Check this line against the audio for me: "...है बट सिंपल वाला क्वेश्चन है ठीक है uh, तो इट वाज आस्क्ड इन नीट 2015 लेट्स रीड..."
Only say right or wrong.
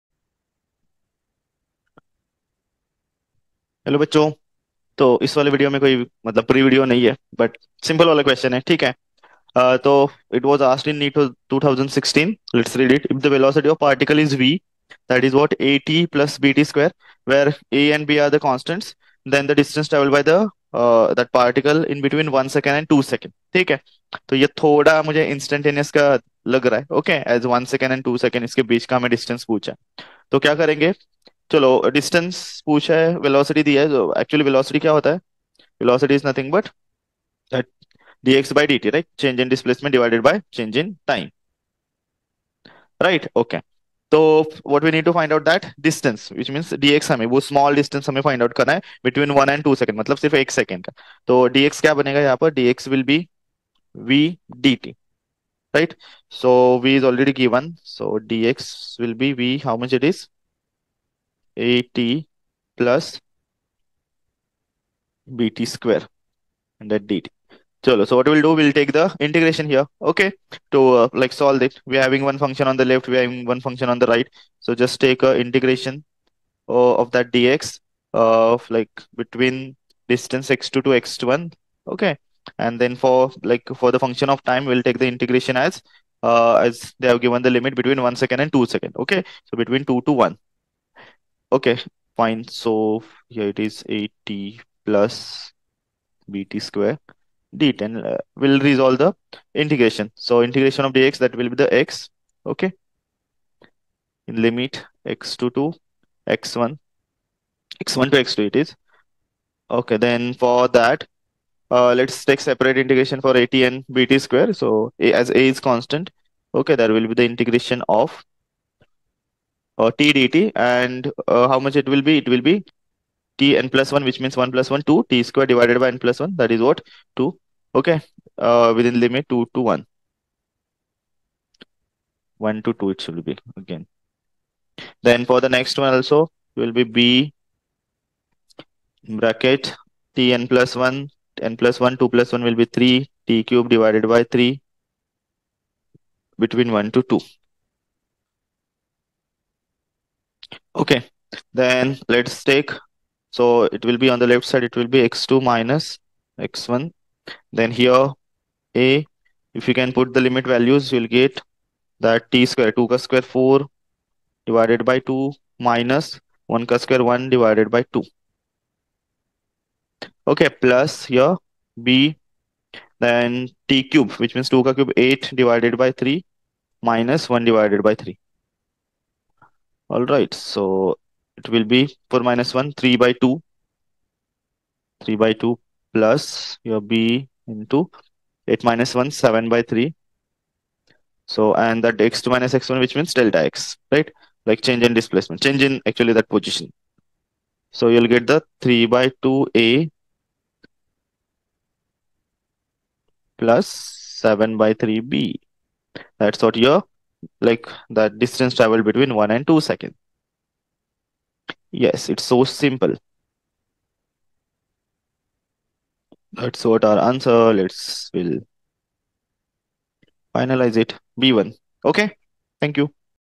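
wrong.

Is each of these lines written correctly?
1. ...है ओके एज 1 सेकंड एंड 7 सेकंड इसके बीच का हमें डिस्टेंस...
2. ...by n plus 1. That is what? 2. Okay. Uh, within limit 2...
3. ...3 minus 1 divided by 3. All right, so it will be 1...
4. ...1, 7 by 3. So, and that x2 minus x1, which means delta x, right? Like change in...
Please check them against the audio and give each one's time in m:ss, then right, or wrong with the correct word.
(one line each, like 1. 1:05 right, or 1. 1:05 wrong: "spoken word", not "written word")
1. 0:26 wrong: "2", not "7"
2. 2:05 right
3. 2:55 wrong: "4", not "1"
4. 3:08 right.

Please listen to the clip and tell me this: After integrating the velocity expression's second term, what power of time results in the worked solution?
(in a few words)
t cube divided by 3.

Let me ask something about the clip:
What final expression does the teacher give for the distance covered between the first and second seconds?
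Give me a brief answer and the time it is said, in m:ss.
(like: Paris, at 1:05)
3/2 a + 7/3 b, at 3:18.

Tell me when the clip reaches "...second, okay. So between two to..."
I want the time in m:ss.
1:28.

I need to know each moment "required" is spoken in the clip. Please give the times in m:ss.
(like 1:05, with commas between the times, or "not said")
not said.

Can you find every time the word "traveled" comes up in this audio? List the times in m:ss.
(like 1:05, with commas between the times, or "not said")
0:19, 3:28.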